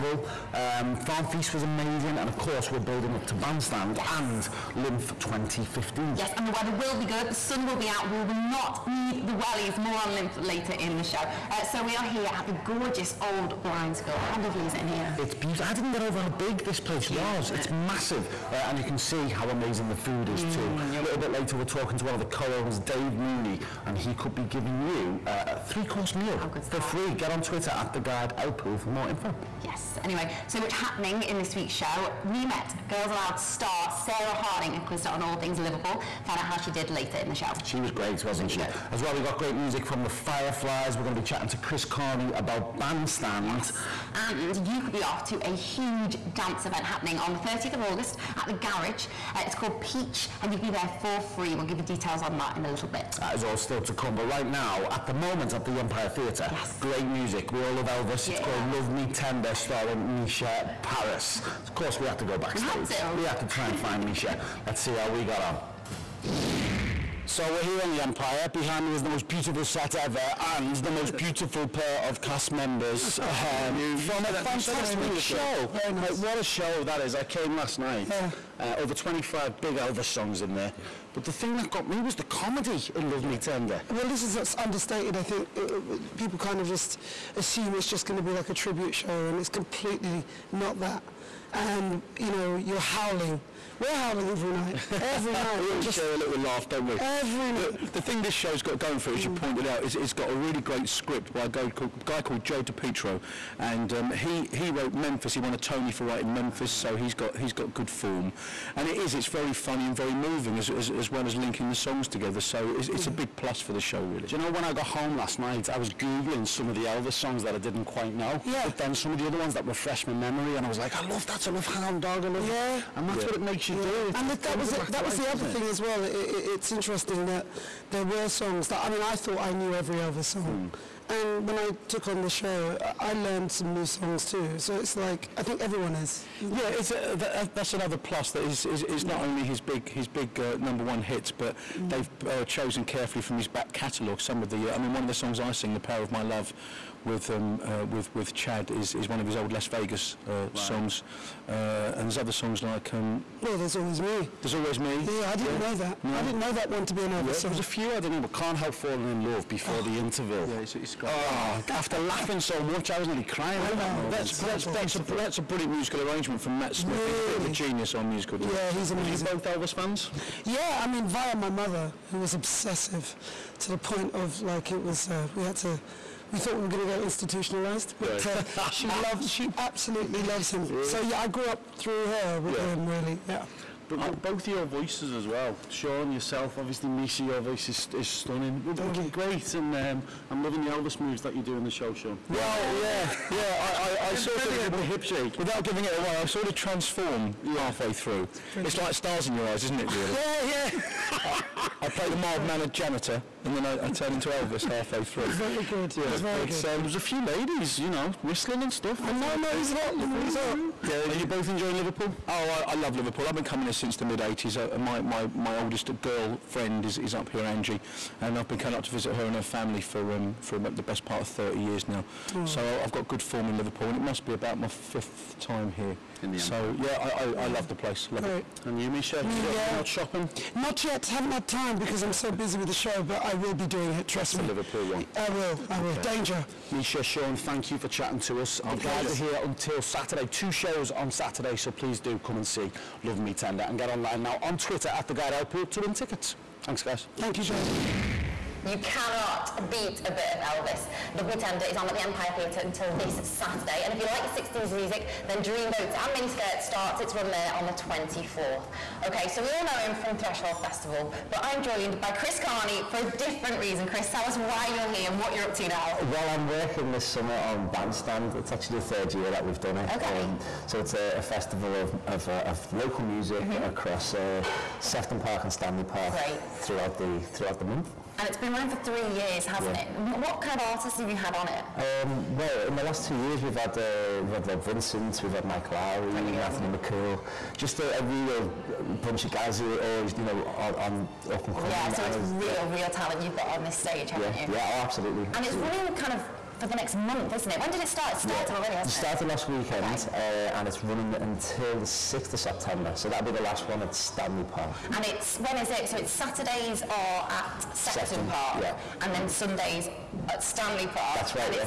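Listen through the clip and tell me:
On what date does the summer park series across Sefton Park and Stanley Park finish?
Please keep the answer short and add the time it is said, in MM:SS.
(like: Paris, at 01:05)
6 September, at 05:01.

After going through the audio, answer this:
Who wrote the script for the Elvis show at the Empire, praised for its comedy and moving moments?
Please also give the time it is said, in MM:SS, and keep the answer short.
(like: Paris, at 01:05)
Joe DiPietro, at 01:42.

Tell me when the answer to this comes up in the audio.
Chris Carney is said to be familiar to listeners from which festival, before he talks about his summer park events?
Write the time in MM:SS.
04:20.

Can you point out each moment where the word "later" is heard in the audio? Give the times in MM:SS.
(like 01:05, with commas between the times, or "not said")
00:10, 00:21, 00:36.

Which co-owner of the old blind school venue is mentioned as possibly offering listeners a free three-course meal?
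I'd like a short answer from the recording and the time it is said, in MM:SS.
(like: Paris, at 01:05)
Dave Mooney, at 00:22.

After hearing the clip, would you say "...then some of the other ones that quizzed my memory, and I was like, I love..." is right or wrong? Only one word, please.
wrong.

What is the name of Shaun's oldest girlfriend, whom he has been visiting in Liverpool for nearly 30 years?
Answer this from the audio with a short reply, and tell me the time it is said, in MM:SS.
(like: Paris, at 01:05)
Angie, at 03:37.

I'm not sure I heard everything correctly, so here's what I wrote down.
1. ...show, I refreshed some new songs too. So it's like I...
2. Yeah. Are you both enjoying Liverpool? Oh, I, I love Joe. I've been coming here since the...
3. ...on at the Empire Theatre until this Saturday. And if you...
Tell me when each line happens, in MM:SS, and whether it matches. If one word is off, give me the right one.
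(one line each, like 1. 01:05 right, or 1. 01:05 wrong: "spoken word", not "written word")
1. 02:12 wrong: "learned", not "refreshed"
2. 03:30 wrong: "Liverpool", not "Joe"
3. 04:11 right.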